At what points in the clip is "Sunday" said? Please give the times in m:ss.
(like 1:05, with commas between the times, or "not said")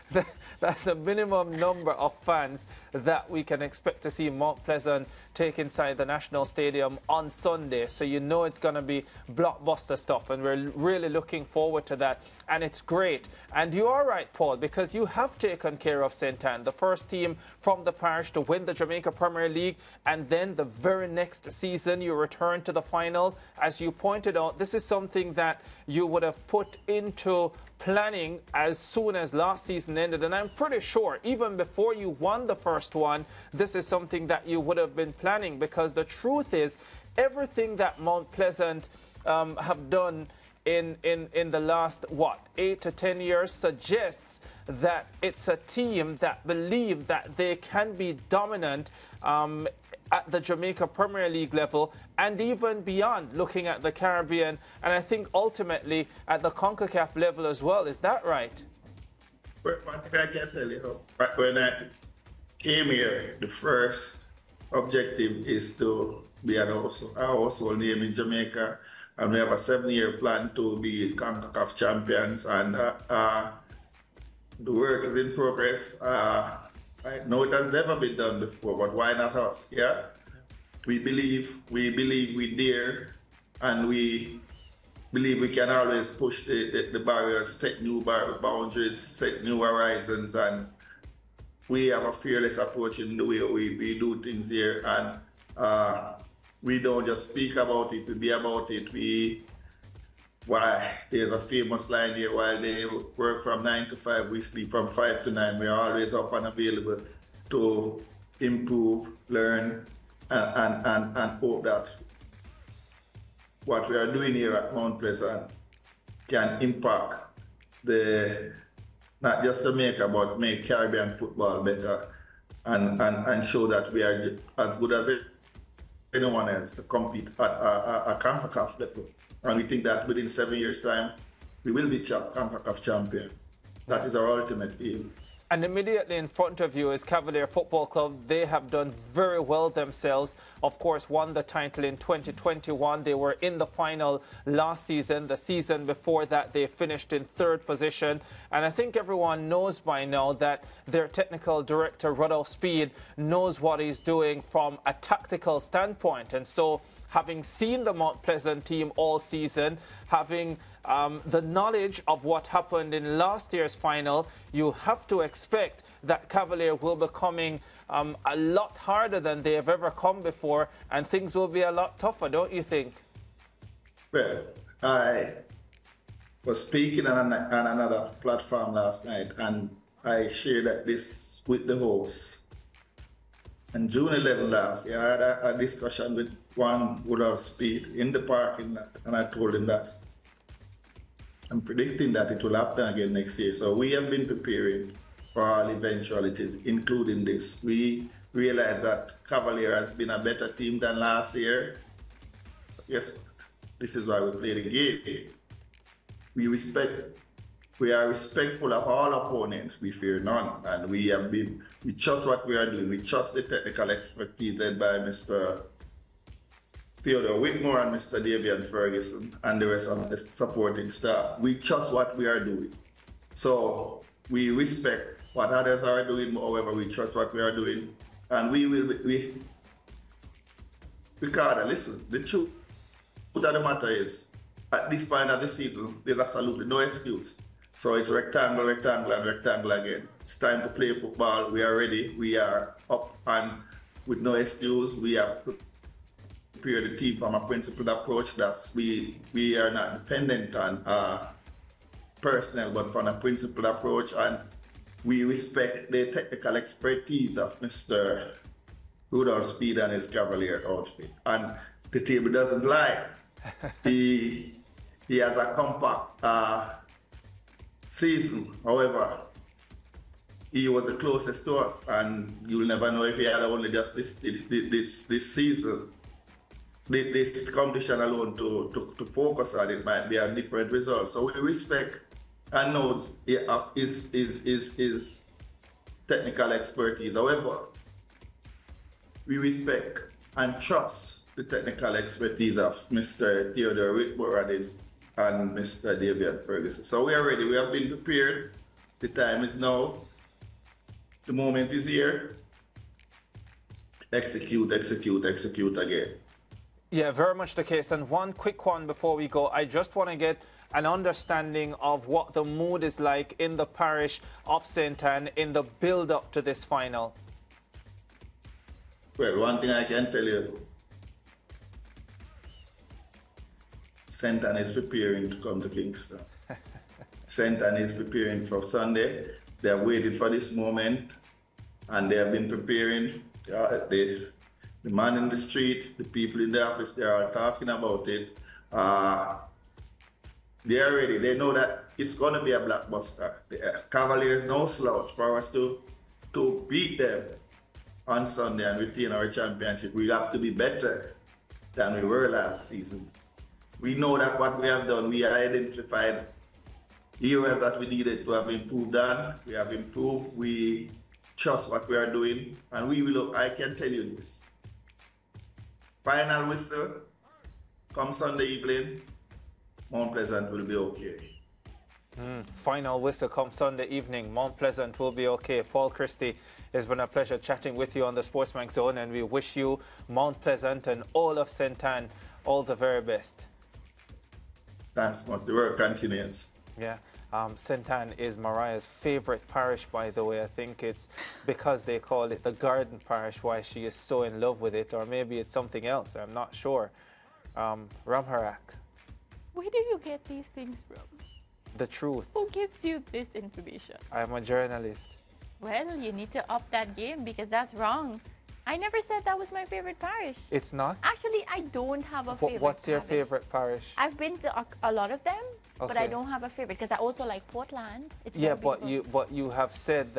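0:07, 5:28, 5:48, 6:08, 6:13.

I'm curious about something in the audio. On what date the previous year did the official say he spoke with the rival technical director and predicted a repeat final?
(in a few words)
June 11.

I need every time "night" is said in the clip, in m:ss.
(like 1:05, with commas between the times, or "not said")
2:59.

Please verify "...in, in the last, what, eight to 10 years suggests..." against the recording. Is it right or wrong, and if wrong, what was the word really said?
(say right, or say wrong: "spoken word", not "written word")
right.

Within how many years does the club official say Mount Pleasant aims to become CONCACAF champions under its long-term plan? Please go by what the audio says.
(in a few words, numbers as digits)
7.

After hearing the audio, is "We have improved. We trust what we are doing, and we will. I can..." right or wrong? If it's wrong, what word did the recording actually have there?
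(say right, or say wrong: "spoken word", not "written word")
right.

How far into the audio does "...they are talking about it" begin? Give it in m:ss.
5:36.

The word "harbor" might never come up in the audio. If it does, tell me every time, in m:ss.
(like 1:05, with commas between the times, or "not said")
not said.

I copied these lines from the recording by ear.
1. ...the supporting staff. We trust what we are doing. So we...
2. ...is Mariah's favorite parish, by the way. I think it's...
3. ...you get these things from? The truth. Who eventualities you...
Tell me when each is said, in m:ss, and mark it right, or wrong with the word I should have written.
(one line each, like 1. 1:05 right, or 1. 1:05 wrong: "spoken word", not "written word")
1. 3:40 right
2. 6:28 right
3. 6:39 wrong: "gives", not "eventualities".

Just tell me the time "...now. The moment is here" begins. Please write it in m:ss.
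4:59.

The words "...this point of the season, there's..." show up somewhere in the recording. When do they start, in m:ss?
3:54.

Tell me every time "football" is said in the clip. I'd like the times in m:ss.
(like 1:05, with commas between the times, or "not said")
2:01, 2:17, 4:00.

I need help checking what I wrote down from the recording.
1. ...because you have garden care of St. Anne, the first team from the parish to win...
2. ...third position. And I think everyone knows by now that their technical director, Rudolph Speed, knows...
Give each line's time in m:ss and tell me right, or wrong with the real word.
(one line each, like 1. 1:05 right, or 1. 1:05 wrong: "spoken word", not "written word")
1. 0:14 wrong: "taken", not "garden"
2. 2:27 right.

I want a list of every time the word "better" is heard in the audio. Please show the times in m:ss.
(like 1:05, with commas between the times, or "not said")
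2:01, 3:20, 5:50.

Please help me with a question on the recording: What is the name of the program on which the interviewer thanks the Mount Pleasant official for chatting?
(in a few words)
SportsMax Zone.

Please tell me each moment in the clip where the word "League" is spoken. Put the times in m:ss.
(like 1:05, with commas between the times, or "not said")
0:19, 0:51.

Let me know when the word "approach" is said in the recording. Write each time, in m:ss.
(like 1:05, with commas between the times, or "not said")
1:32, 4:07, 4:13.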